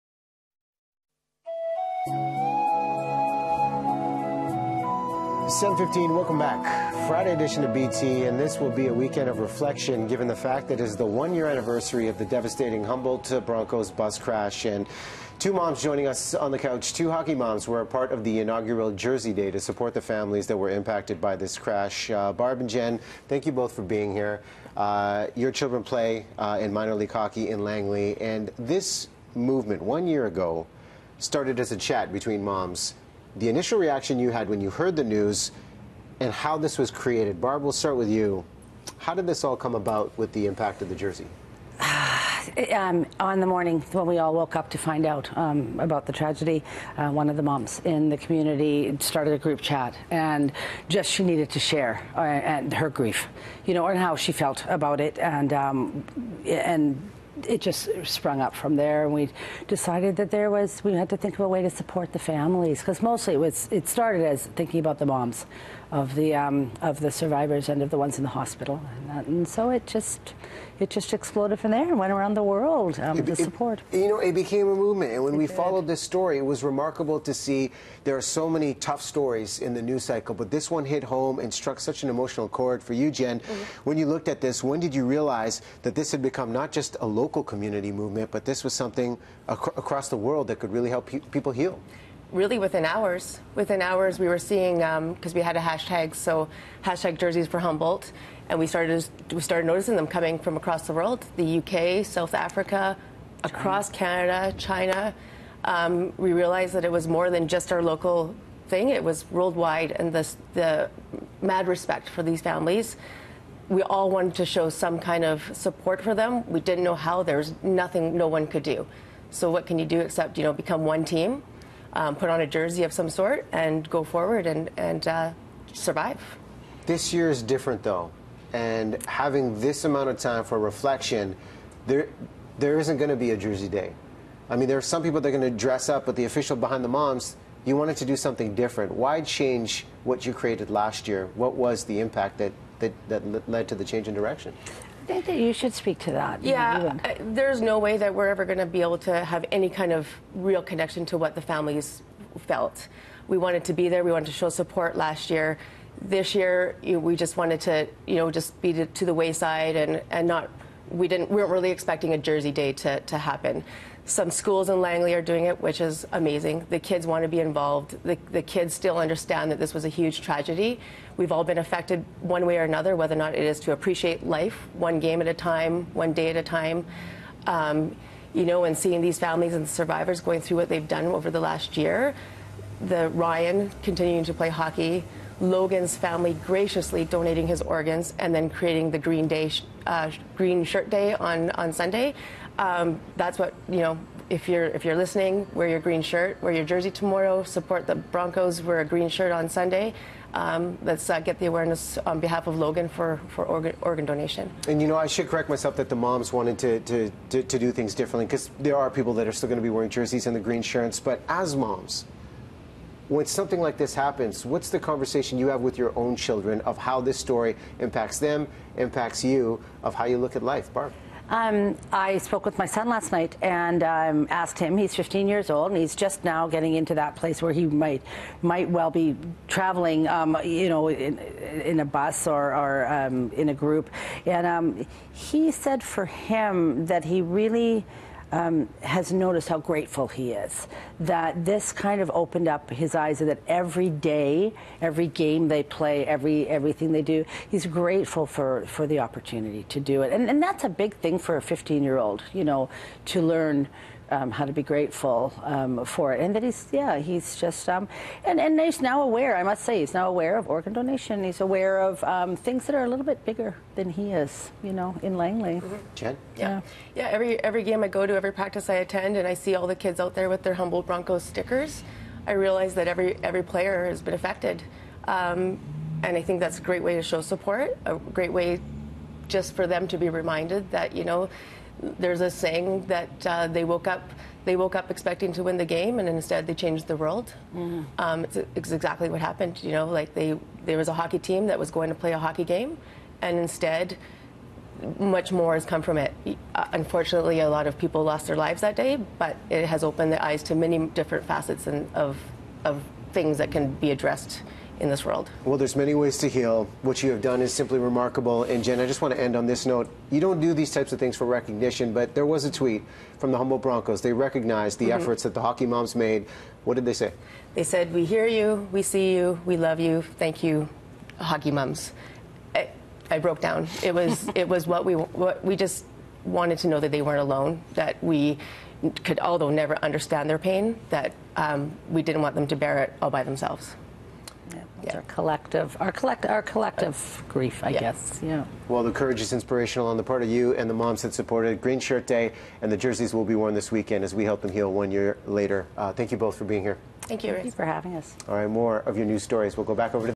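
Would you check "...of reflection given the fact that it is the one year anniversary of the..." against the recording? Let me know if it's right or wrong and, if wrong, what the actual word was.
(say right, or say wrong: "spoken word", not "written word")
right.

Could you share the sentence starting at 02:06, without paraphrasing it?
This year is different though, and having this amount of time for reflection, there there isn't going to be a jersey day.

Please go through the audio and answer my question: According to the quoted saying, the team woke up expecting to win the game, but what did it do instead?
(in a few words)
changed the world.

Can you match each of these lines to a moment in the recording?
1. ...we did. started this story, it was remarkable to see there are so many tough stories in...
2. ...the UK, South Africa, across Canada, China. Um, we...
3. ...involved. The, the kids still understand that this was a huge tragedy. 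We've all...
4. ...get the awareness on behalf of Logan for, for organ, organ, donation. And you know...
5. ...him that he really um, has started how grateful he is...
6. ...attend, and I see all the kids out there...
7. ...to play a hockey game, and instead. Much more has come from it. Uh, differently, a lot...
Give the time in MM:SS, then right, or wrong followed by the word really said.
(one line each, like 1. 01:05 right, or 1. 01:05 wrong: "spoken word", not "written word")
1. 01:15 wrong: "followed", not "started"
2. 01:41 right
3. 02:47 right
4. 03:21 right
5. 03:56 wrong: "noticed", not "started"
6. 04:28 right
7. 04:51 wrong: "unfortunately", not "differently".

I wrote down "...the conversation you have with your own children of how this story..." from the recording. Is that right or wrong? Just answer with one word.
right.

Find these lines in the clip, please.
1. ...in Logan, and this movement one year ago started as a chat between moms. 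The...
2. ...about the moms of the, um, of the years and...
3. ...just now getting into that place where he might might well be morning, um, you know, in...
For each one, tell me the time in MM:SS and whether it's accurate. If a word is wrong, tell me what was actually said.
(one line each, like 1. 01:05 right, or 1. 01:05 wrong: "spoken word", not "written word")
1. 00:27 wrong: "Langley", not "Logan"
2. 01:04 wrong: "survivors", not "years"
3. 03:45 wrong: "traveling", not "morning".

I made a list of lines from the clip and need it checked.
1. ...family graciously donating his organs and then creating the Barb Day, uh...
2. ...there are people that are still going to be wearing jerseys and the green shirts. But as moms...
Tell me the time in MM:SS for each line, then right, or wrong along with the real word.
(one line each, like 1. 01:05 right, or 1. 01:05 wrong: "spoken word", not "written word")
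1. 03:05 wrong: "Green", not "Barb"
2. 03:28 right.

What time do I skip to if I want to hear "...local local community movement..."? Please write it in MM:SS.
01:27.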